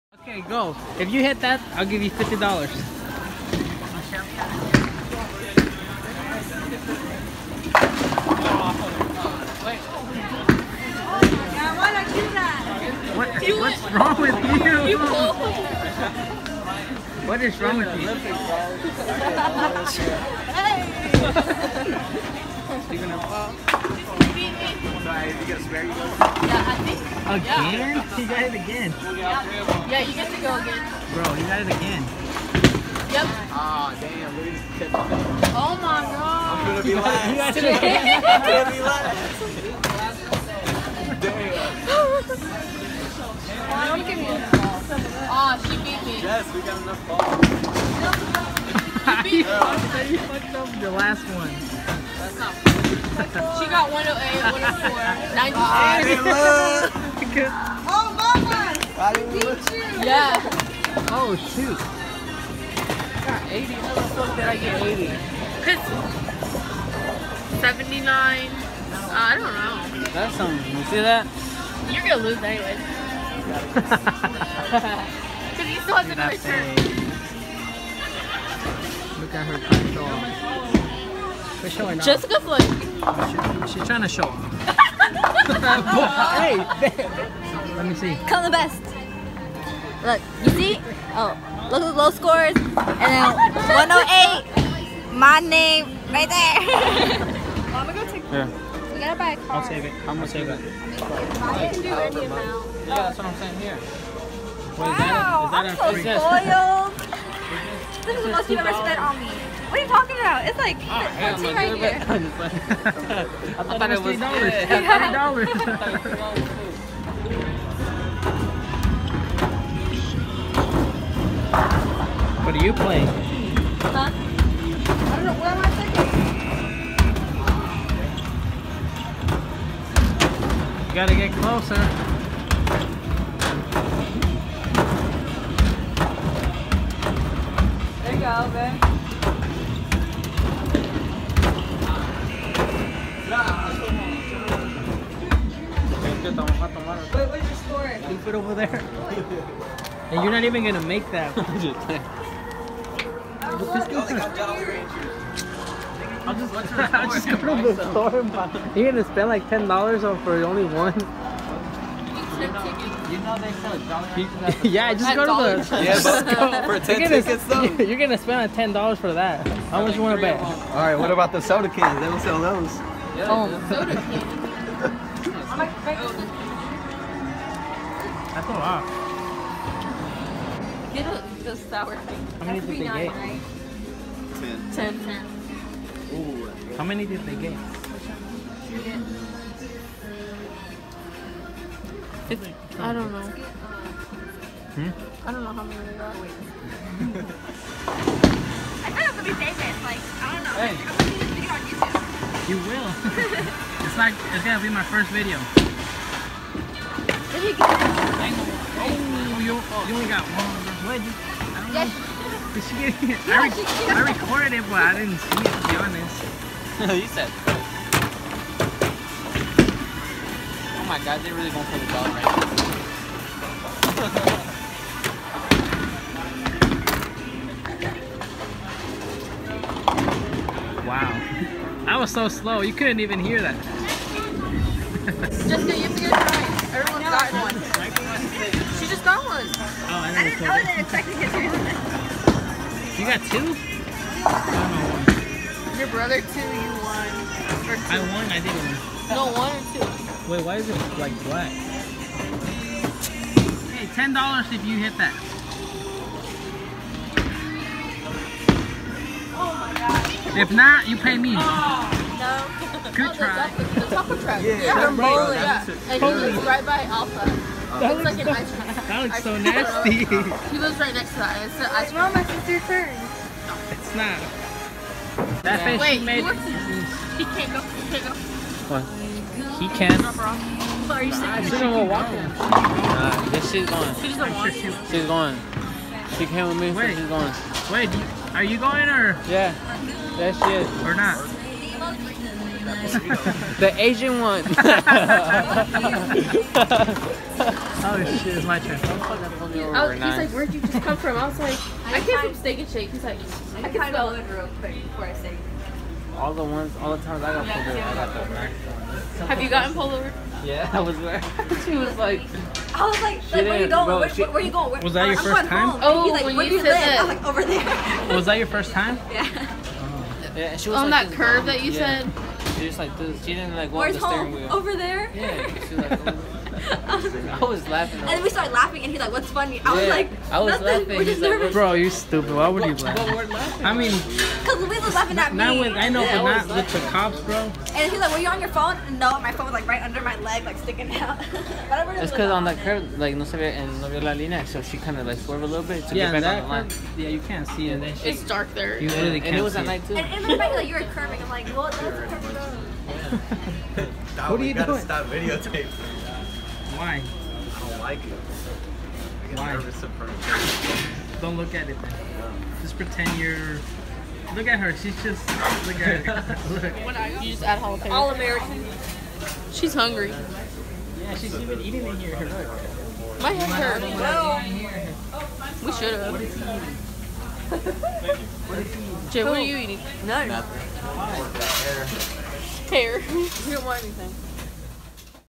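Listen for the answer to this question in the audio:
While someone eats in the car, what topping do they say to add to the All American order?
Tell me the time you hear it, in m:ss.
6:07.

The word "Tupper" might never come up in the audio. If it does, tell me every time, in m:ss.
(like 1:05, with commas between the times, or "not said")
4:23.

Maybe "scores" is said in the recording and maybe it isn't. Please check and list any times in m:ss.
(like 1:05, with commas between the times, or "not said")
1:32, 2:27.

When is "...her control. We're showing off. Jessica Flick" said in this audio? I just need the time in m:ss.
1:19.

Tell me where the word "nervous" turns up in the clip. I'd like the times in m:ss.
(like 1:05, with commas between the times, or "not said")
5:31, 5:59.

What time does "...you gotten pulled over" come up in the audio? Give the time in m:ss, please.
5:09.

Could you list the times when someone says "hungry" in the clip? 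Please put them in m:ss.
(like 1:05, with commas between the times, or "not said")
6:09.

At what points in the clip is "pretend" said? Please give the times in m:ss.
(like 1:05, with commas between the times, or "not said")
6:02.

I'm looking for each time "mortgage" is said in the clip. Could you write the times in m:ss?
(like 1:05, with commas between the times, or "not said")
not said.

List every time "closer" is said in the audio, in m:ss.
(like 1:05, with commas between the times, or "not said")
2:11.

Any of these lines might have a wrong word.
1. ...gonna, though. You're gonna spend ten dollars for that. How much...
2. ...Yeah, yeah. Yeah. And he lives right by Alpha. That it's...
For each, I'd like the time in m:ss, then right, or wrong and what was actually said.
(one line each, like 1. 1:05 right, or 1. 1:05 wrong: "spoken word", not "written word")
1. 2:47 right
2. 4:24 right.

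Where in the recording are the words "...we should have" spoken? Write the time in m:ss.
6:15.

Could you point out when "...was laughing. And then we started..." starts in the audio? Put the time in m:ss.
5:27.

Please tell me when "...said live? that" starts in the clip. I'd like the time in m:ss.
5:16.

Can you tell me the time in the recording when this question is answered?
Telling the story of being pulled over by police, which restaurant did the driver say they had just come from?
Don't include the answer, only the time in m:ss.
5:02.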